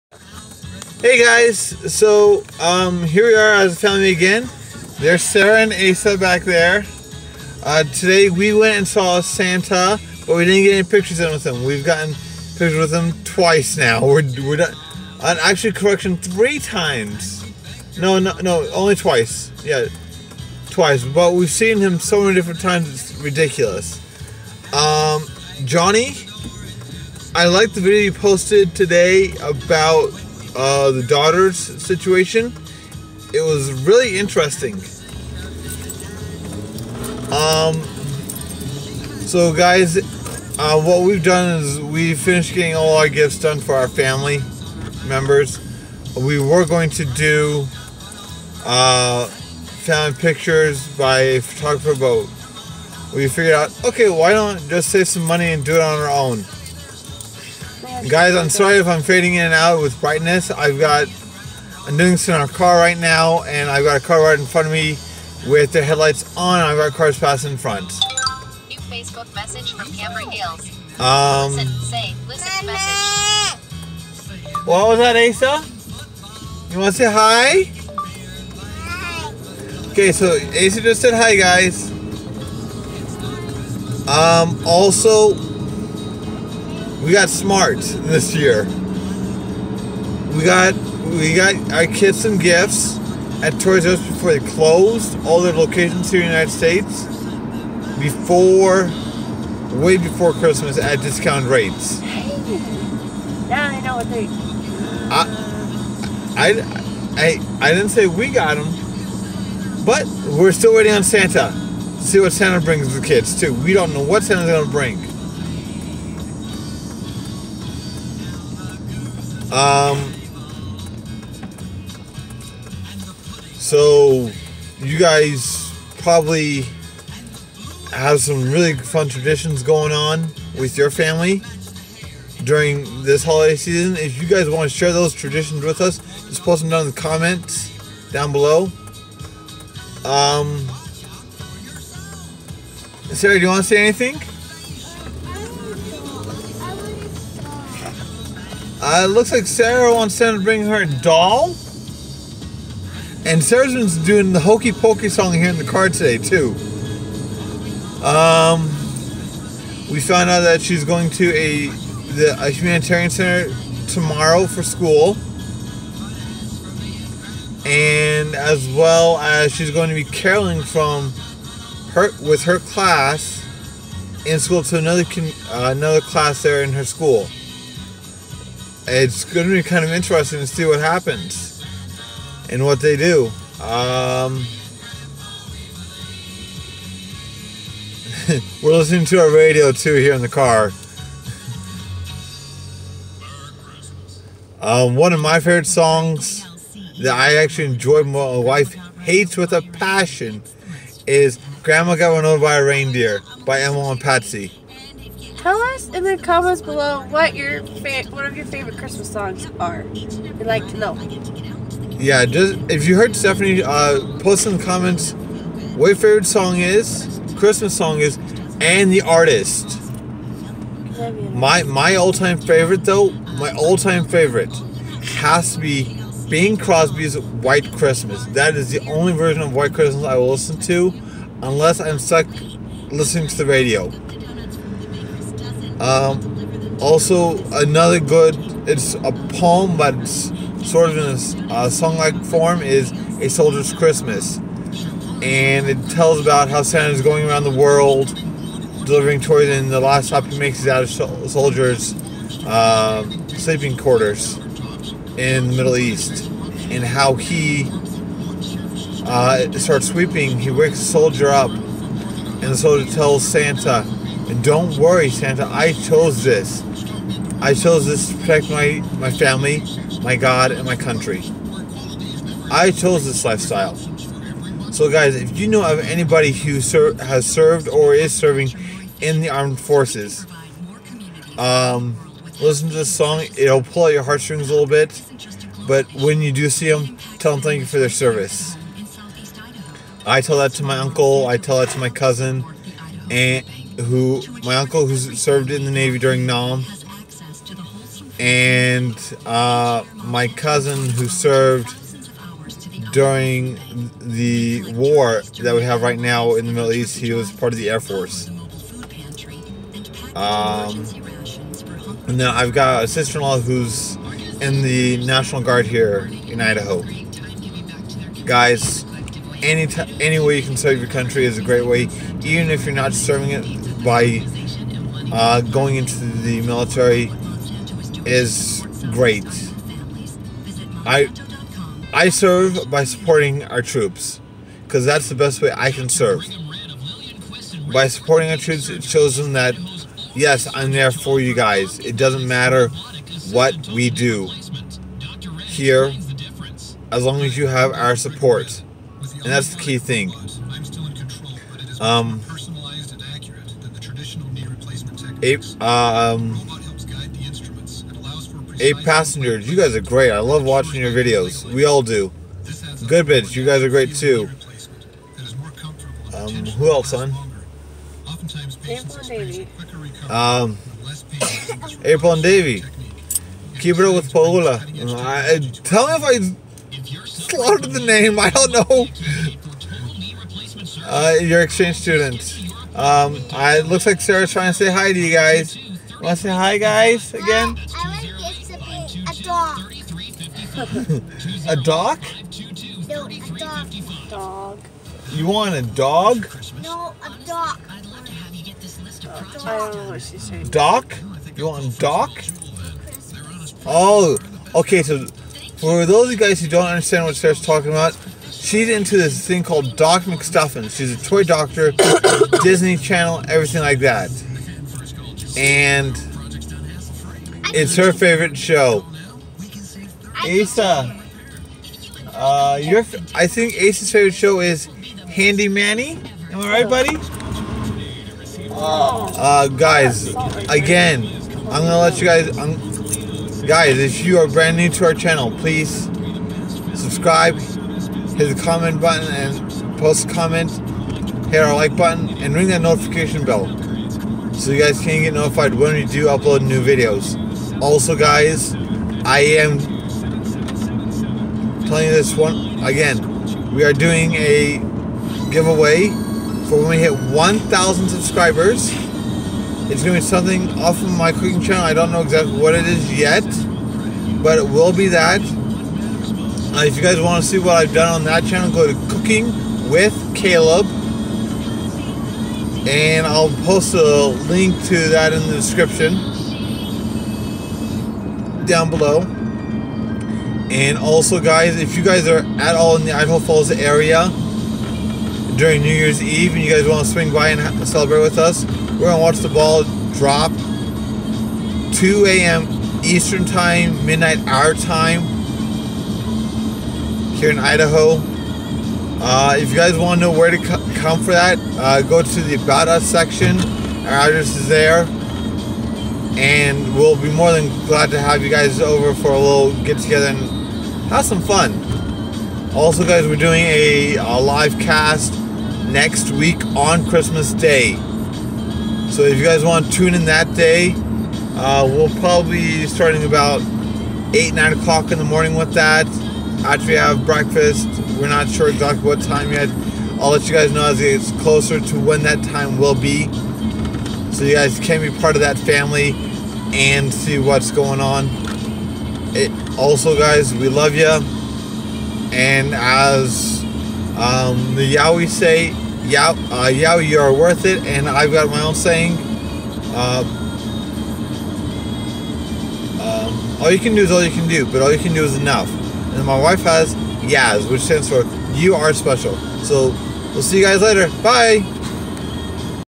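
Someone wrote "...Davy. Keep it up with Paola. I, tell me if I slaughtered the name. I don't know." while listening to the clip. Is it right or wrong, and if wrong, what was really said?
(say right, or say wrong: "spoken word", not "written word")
right.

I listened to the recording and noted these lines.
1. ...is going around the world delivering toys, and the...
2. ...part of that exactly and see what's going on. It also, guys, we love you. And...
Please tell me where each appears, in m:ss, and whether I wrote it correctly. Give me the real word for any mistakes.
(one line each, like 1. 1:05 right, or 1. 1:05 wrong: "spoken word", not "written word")
1. 4:06 right
2. 8:54 wrong: "family", not "exactly".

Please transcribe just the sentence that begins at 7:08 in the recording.
Uh, guys, again, I'm gonna let you guys.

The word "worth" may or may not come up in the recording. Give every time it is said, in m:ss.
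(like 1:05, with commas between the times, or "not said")
9:07.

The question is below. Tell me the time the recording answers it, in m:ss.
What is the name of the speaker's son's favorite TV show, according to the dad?
7:05.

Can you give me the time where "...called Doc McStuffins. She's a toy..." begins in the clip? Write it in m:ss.
6:49.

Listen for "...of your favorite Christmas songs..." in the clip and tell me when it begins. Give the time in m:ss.
3:28.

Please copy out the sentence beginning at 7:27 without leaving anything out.
Also, guys, I am telling you this one again.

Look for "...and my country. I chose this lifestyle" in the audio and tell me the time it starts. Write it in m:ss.
4:30.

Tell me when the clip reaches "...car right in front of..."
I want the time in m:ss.
1:04.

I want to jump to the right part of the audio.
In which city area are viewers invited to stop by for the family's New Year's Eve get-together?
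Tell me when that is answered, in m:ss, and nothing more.
8:02.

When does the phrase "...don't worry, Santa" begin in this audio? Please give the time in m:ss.
4:24.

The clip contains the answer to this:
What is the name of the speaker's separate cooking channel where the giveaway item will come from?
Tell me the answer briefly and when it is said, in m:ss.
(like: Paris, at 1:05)
Cooking with Caleb, at 7:48.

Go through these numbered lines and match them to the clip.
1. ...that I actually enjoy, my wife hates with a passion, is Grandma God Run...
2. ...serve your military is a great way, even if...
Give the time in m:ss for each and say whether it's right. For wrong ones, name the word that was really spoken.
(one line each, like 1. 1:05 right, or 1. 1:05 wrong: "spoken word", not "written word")
1. 3:17 wrong: "Got", not "God"
2. 5:20 wrong: "country", not "military".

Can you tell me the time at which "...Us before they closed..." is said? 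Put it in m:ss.
1:33.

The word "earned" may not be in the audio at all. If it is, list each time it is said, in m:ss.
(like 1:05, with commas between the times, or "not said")
not said.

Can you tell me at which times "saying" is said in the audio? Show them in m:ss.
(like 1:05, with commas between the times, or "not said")
6:40, 9:08.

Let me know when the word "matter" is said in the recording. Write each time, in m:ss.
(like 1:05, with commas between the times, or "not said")
5:42.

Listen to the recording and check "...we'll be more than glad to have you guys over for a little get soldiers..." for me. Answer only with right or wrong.
wrong.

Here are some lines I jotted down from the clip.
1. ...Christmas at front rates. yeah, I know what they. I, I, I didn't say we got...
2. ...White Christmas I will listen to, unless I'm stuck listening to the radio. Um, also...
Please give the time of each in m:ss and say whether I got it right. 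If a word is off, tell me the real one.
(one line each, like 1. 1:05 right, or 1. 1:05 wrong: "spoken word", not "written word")
1. 1:40 wrong: "discount", not "front"
2. 3:49 right.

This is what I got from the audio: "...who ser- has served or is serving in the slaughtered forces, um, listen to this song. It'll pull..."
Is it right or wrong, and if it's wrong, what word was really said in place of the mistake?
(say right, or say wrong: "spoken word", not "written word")
wrong: "armed", not "slaughtered".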